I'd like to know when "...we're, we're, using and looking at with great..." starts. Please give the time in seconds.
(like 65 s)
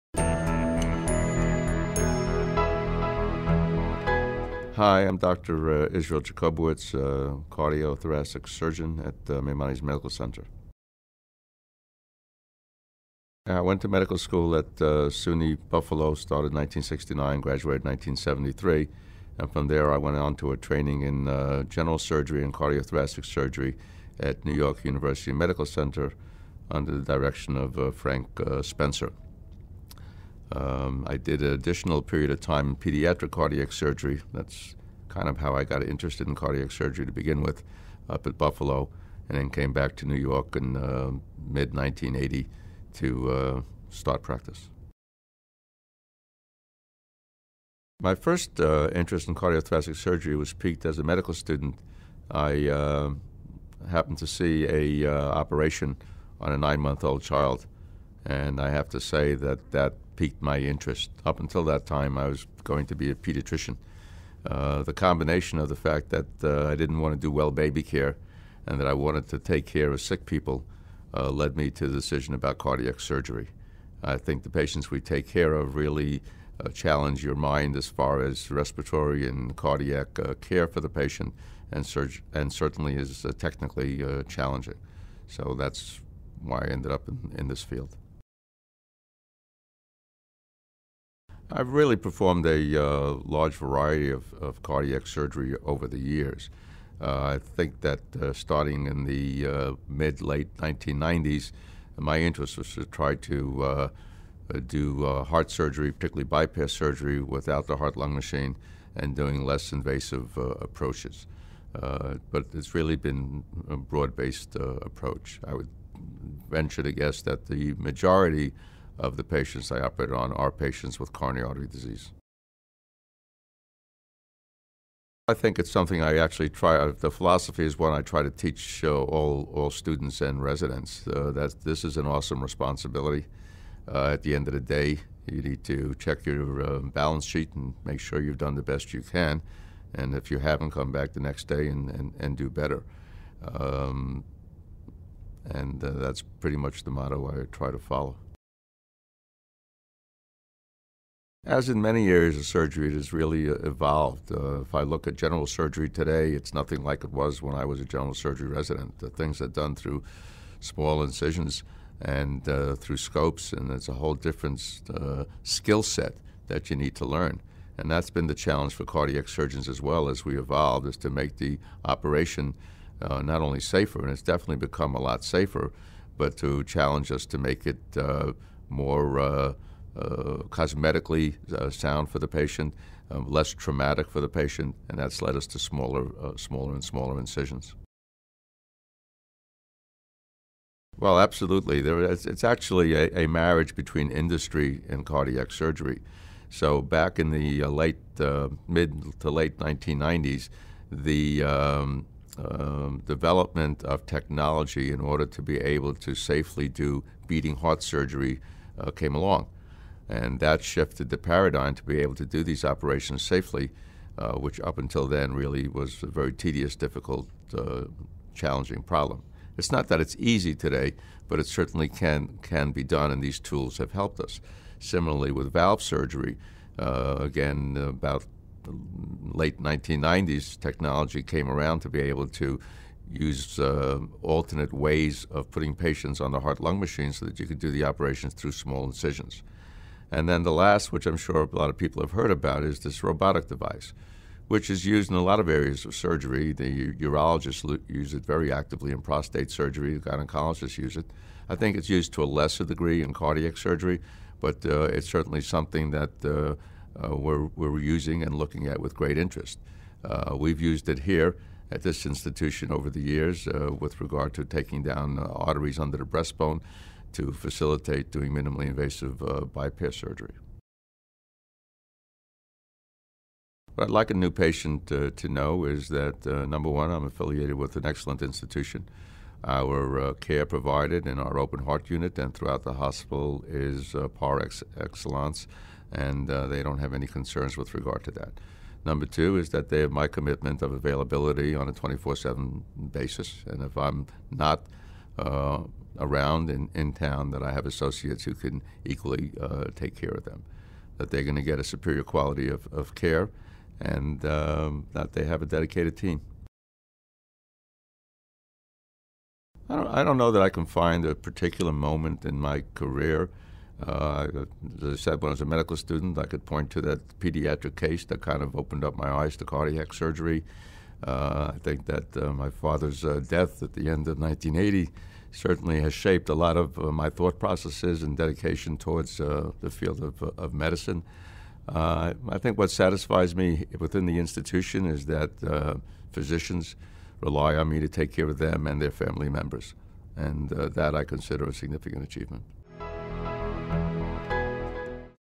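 257 s.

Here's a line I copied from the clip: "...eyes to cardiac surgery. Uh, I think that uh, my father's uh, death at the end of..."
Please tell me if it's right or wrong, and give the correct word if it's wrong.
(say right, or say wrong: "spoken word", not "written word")
right.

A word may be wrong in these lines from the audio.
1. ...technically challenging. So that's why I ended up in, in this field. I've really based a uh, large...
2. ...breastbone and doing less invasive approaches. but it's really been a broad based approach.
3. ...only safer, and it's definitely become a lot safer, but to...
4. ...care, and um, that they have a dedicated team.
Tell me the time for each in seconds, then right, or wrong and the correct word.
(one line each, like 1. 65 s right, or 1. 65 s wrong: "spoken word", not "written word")
1. 83 s wrong: "performed", not "based"
2. 108 s wrong: "machine", not "breastbone"
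3. 173 s right
4. 302 s right.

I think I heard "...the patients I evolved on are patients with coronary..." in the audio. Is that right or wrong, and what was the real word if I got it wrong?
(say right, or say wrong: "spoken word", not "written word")
wrong: "operated", not "evolved".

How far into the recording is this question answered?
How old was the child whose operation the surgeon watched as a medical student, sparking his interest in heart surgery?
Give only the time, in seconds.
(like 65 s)
56 s.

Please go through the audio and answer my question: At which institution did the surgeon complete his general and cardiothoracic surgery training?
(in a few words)
New York University Medical Center.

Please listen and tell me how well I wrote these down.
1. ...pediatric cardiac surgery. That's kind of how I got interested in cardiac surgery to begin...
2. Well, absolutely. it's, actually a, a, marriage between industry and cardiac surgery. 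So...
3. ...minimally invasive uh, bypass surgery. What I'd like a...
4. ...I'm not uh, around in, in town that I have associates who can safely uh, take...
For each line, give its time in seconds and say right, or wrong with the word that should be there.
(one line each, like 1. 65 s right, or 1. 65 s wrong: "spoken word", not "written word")
1. 32 s right
2. 190 s right
3. 268 s right
4. 293 s wrong: "equally", not "safely".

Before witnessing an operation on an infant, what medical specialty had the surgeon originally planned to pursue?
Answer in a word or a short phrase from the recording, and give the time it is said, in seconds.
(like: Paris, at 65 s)
Pediatrician, at 63 s.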